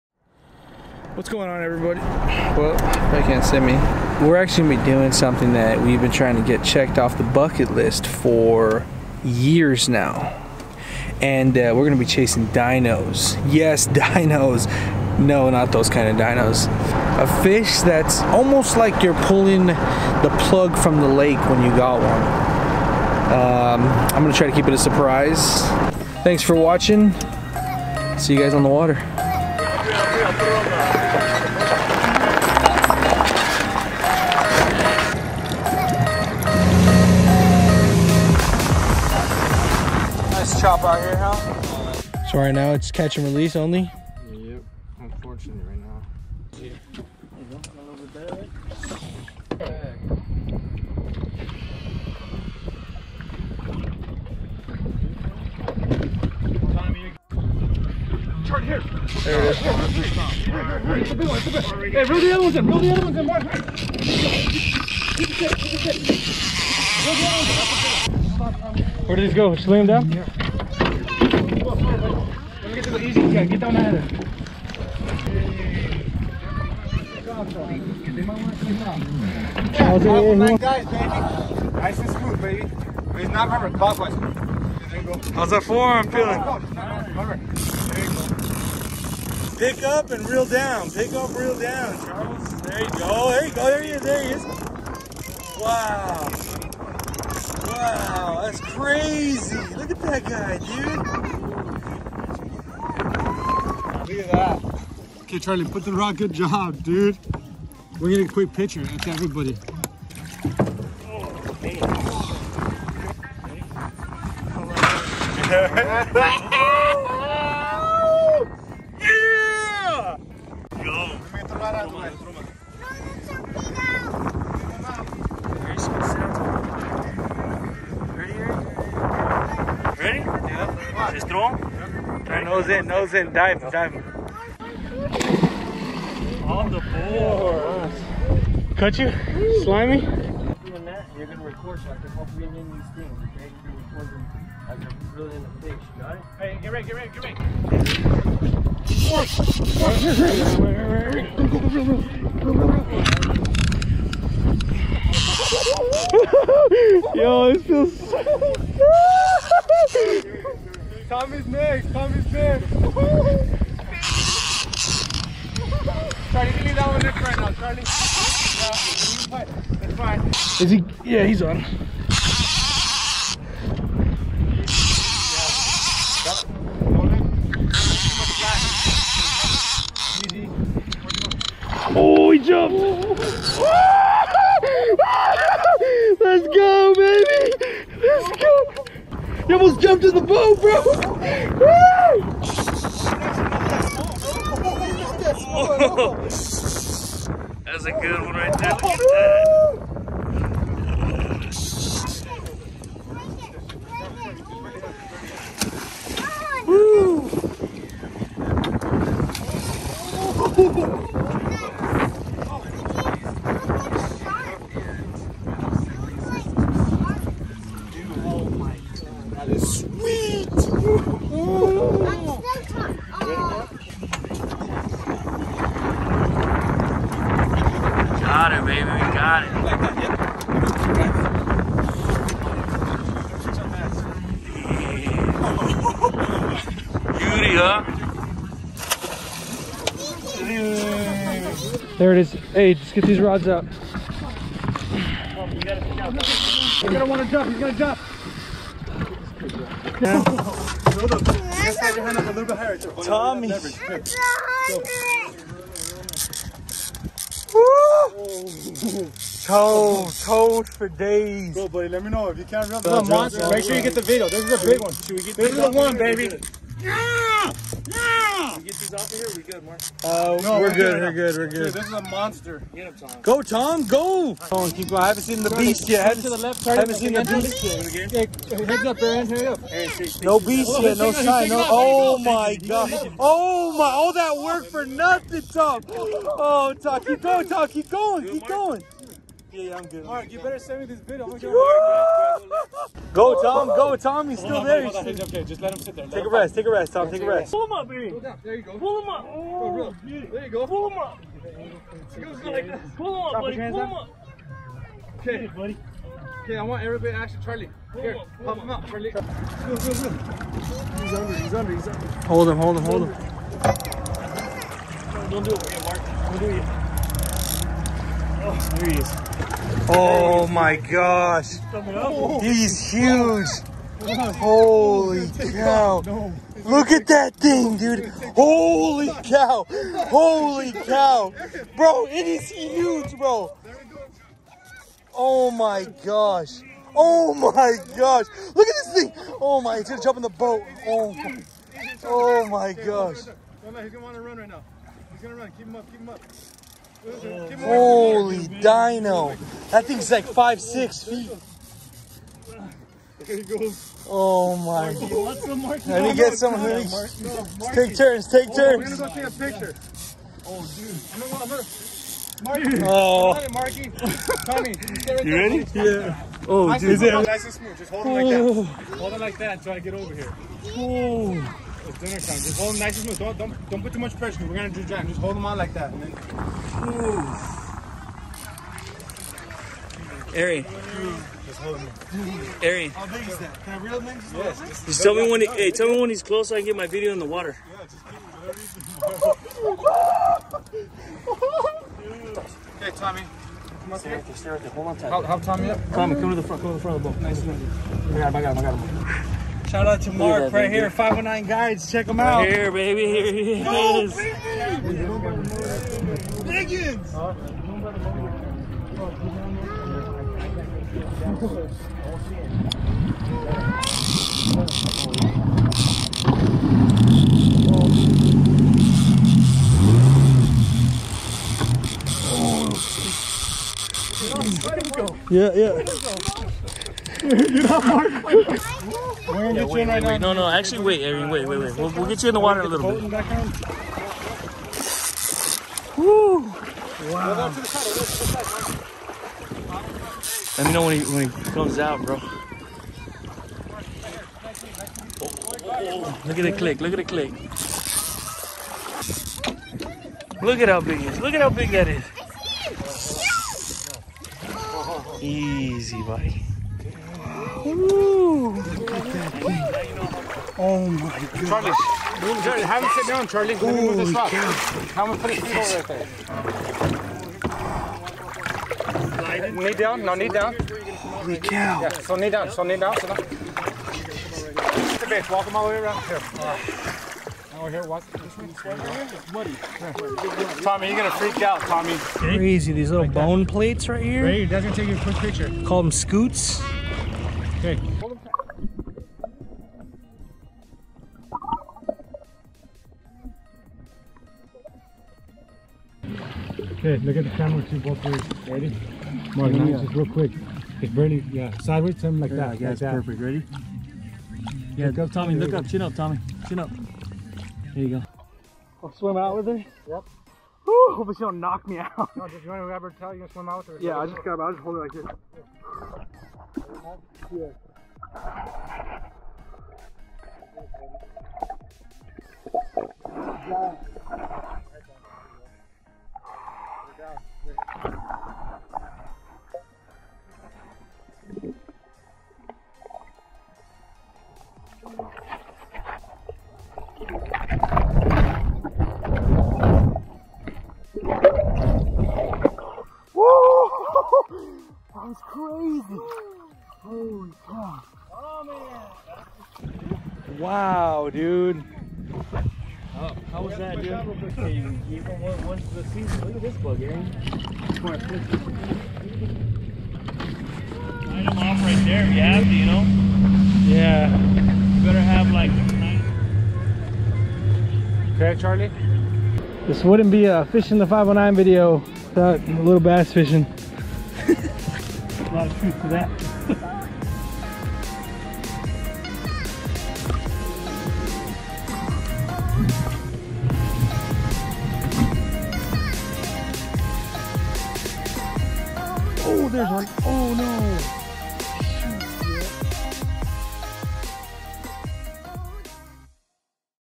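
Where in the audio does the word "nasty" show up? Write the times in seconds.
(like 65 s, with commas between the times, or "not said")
not said.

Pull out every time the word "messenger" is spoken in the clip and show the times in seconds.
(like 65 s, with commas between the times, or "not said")
not said.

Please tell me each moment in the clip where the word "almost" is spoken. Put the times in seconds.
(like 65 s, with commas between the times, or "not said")
18 s, 189 s.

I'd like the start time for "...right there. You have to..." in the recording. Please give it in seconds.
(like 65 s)
561 s.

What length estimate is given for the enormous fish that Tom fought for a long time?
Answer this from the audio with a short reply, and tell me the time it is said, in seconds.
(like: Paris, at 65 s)
5 to 6 feet, at 350 s.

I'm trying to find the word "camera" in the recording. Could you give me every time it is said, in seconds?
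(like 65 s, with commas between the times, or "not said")
497 s.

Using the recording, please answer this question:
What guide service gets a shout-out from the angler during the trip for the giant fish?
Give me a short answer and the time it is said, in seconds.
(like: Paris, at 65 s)
509 Guides, at 400 s.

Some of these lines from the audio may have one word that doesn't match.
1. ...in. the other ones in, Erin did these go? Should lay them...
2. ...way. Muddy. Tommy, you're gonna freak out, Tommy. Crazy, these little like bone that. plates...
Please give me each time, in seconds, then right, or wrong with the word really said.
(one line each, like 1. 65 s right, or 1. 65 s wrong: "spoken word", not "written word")
1. 62 s wrong: "Where", not "Erin"
2. 478 s right.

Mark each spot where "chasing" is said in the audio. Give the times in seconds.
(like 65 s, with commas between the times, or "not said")
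12 s.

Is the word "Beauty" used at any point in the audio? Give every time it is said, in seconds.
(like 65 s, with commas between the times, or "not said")
237 s.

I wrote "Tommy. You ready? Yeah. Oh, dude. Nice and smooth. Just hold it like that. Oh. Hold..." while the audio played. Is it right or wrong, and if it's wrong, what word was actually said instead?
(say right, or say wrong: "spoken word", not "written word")
right.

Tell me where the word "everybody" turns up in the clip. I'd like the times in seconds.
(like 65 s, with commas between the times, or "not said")
1 s, 109 s, 306 s.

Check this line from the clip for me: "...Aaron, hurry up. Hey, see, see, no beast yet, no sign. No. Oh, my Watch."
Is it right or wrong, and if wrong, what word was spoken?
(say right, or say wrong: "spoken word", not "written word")
wrong: "God", not "Watch".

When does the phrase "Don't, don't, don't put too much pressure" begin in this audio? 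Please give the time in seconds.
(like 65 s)
373 s.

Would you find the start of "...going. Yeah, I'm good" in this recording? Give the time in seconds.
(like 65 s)
288 s.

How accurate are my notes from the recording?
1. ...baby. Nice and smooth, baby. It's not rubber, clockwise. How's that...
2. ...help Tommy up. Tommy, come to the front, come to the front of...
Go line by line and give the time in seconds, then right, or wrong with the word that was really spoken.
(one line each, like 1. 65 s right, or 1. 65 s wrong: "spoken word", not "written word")
1. 80 s right
2. 395 s right.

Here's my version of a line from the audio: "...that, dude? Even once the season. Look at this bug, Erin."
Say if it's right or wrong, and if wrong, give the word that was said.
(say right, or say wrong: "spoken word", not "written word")
wrong: "Aaron", not "Erin".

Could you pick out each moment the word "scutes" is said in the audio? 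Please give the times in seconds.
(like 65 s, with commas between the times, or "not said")
485 s.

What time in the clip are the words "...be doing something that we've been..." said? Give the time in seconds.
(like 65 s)
4 s.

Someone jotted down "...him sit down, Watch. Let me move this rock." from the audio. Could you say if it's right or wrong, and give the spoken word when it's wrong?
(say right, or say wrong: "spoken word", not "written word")
wrong: "Charlie", not "Watch".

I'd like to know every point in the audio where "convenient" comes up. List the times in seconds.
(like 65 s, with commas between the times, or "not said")
not said.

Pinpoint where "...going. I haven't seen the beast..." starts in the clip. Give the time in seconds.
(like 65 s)
274 s.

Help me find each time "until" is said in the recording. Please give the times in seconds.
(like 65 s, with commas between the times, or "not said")
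369 s.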